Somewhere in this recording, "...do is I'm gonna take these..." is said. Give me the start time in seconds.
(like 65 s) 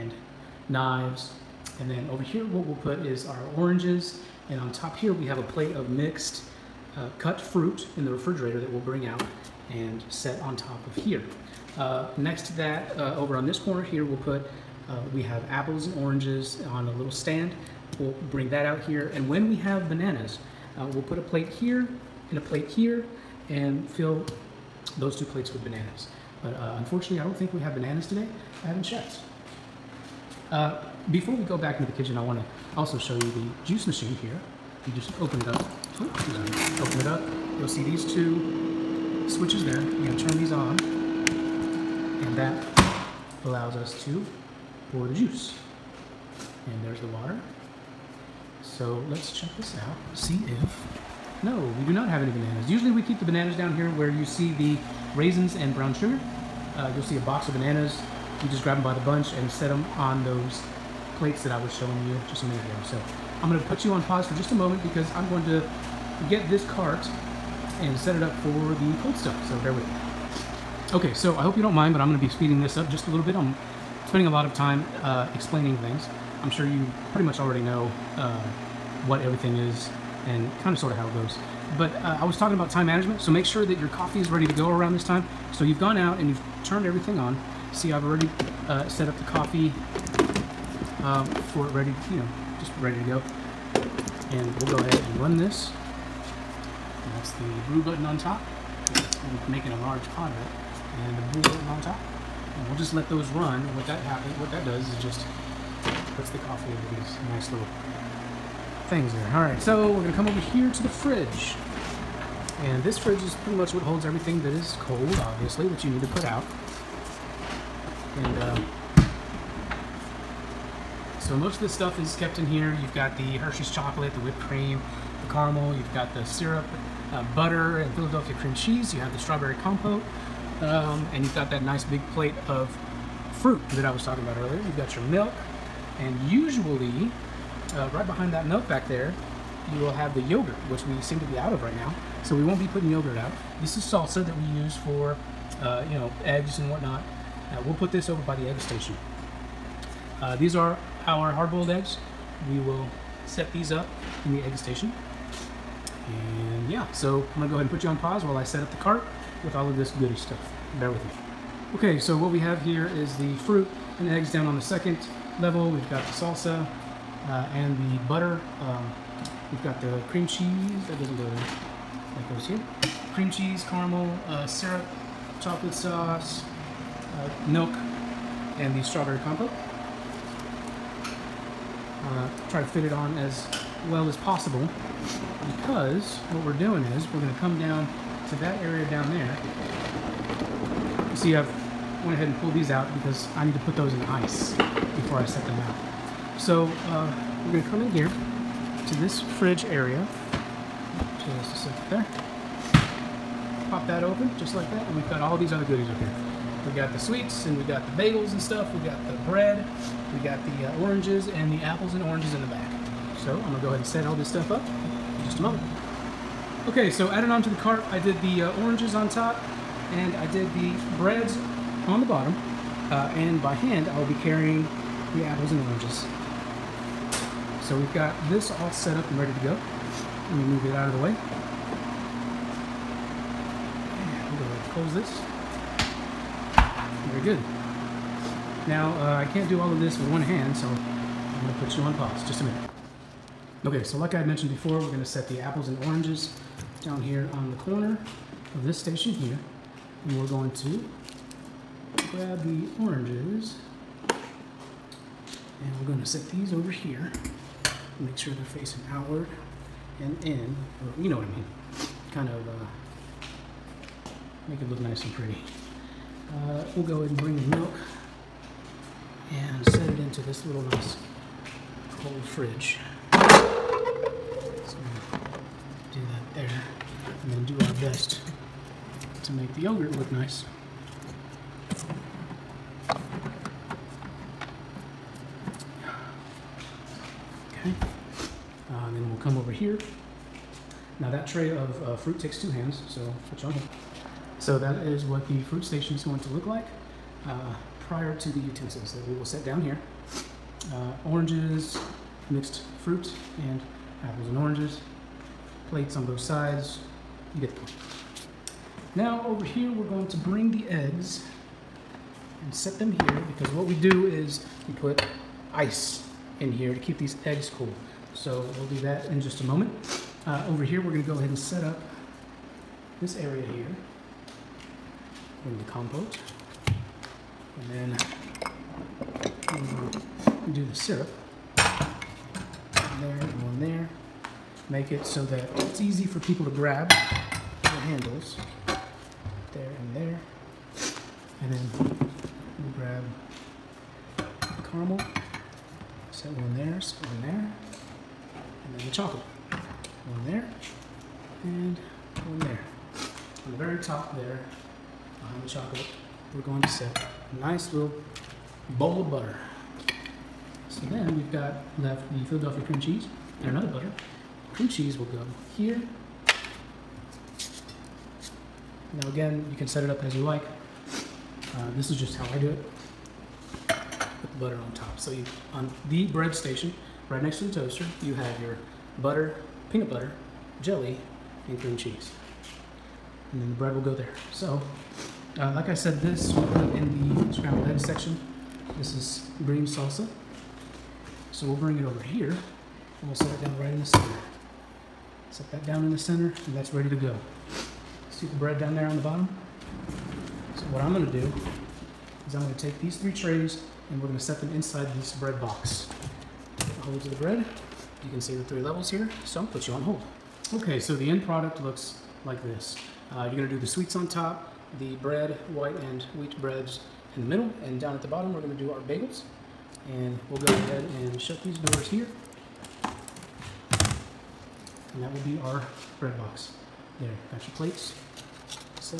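401 s.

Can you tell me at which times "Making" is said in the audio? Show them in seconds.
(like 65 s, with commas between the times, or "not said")
99 s.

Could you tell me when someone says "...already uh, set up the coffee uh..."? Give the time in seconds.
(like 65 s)
88 s.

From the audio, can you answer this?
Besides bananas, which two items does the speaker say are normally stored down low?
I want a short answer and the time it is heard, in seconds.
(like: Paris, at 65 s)
raisins and brown sugar, at 55 s.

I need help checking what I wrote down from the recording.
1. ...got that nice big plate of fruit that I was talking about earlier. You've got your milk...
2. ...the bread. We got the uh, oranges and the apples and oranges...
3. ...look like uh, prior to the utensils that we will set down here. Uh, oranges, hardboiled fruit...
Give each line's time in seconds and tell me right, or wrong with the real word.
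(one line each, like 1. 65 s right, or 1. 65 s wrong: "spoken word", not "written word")
1. 131 s right
2. 209 s right
3. 296 s wrong: "mixed", not "hardboiled".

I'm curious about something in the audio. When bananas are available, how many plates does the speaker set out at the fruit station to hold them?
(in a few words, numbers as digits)
2.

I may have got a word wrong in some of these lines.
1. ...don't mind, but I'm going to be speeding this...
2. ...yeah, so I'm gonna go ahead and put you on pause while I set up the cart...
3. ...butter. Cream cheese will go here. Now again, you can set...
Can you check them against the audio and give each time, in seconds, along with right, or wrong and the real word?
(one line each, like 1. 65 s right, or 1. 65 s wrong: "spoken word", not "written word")
1. 71 s right
2. 156 s right
3. 363 s right.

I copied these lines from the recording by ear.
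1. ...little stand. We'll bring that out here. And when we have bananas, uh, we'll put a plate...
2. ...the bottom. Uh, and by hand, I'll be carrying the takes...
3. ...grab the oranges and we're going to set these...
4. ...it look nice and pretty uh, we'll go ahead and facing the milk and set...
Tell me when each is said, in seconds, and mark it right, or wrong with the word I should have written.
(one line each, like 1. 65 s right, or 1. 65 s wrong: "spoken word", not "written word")
1. 16 s right
2. 222 s wrong: "apples", not "takes"
3. 252 s right
4. 264 s wrong: "bring", not "facing".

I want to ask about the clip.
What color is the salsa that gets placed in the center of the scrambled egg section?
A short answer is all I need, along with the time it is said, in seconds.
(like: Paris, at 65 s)
green, at 389 s.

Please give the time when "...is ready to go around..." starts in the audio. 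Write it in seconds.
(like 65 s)
84 s.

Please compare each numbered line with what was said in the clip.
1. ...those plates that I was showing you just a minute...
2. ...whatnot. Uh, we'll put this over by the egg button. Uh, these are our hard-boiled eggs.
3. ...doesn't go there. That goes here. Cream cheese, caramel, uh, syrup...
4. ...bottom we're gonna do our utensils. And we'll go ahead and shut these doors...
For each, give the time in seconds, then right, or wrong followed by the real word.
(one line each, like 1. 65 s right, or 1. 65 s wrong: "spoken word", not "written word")
1. 60 s right
2. 146 s wrong: "station", not "button"
3. 170 s right
4. 418 s wrong: "bagels", not "utensils".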